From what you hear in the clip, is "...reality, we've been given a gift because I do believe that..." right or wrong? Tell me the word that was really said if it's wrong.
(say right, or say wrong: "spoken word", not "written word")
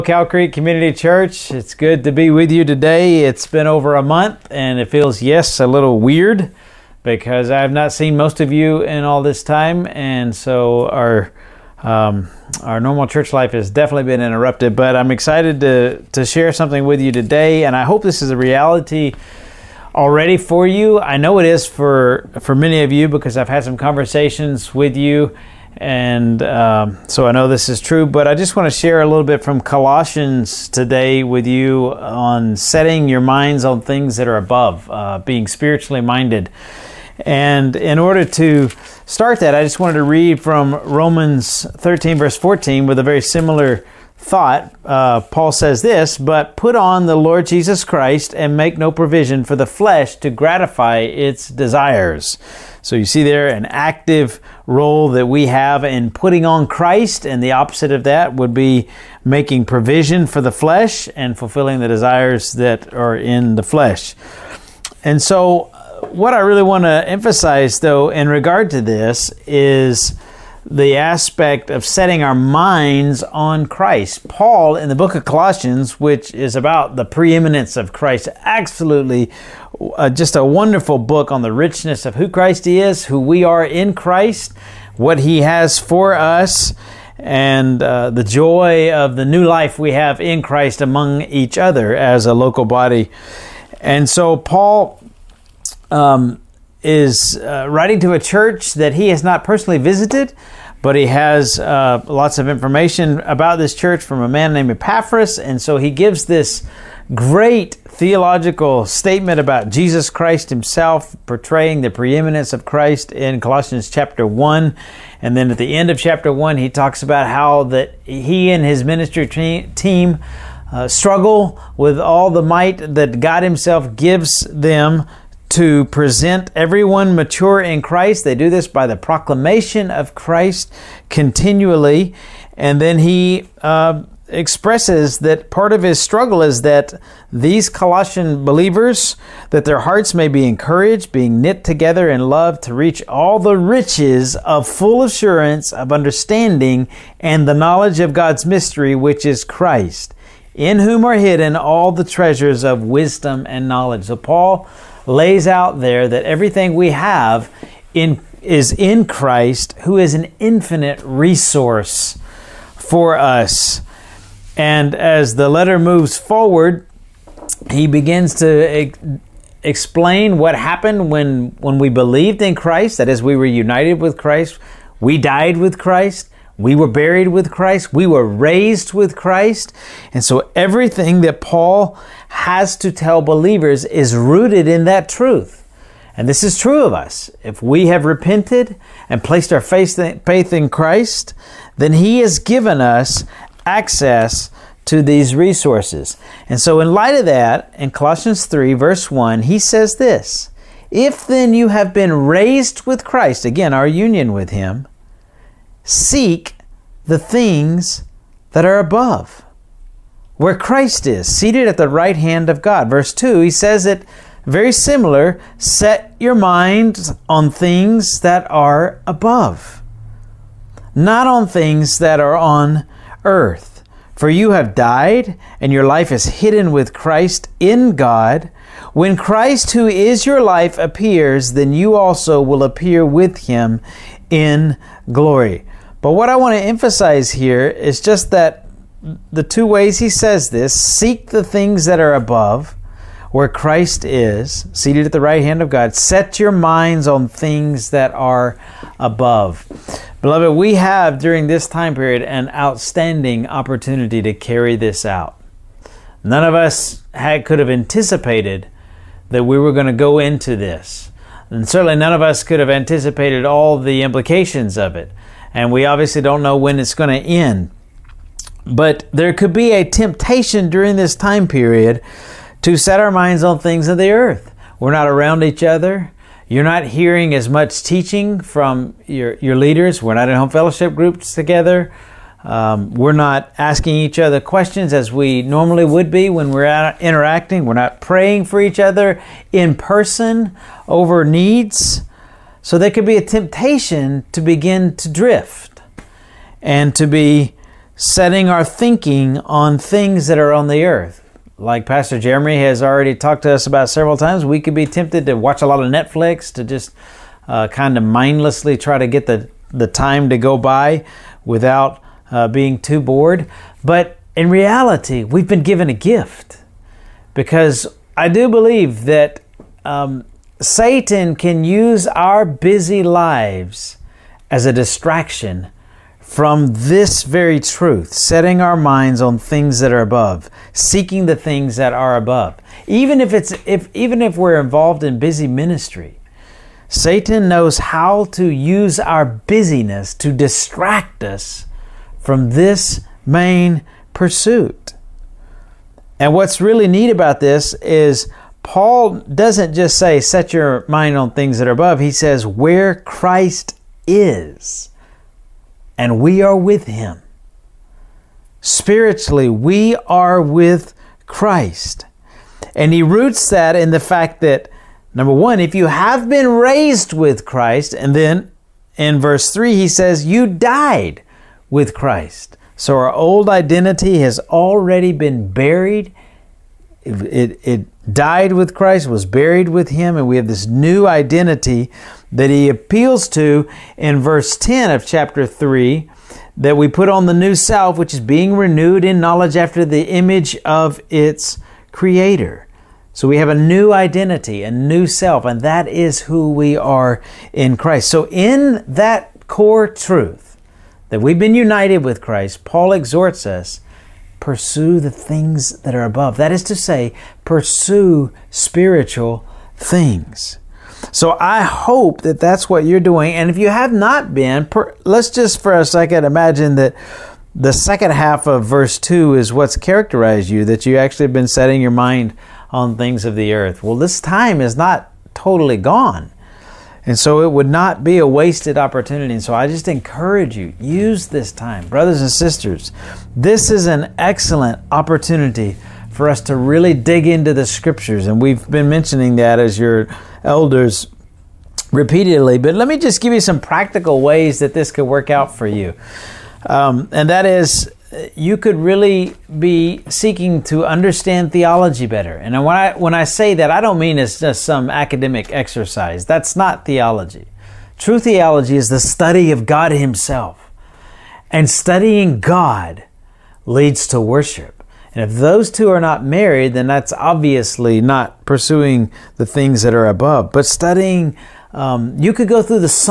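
right.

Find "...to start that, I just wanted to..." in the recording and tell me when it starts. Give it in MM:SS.
00:38.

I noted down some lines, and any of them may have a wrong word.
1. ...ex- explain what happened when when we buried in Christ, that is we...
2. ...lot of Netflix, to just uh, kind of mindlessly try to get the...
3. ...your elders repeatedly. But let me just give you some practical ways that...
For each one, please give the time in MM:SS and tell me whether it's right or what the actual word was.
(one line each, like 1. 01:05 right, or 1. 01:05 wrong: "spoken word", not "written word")
1. 02:48 wrong: "believed", not "buried"
2. 05:05 right
3. 07:19 right.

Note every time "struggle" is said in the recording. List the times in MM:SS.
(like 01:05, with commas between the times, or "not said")
02:00, 02:16.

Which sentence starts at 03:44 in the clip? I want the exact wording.
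For you have died, and your life is hidden with Christ in God.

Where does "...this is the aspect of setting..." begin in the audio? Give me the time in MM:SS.
01:08.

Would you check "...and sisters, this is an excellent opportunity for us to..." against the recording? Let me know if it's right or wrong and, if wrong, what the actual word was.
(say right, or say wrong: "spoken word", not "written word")
right.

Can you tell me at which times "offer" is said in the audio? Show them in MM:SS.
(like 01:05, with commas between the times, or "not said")
not said.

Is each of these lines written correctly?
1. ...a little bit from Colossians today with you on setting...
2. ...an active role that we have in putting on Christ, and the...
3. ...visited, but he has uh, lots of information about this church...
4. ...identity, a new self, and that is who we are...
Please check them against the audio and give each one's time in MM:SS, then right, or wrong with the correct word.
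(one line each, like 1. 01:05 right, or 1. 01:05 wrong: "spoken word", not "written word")
1. 00:29 right
2. 00:53 right
3. 01:39 right
4. 06:33 right.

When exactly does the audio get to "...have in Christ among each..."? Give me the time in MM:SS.
01:29.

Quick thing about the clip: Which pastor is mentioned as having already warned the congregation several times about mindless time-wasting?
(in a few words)
Pastor Jeremy.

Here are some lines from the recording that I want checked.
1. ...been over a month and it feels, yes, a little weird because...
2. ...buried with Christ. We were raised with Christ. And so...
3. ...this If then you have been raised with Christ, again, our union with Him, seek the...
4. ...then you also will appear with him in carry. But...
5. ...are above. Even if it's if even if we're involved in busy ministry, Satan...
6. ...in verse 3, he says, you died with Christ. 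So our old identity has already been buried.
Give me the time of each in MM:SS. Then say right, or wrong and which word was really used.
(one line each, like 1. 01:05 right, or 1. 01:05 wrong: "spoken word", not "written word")
1. 00:03 right
2. 02:56 right
3. 03:19 right
4. 03:51 wrong: "glory", not "carry"
5. 05:31 right
6. 06:08 right.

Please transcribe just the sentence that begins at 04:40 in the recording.
We're not in home fellowship groups together.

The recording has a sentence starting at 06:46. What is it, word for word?
That is to say, pursue spiritual things.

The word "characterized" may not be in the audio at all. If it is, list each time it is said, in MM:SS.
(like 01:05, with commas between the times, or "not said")
06:59.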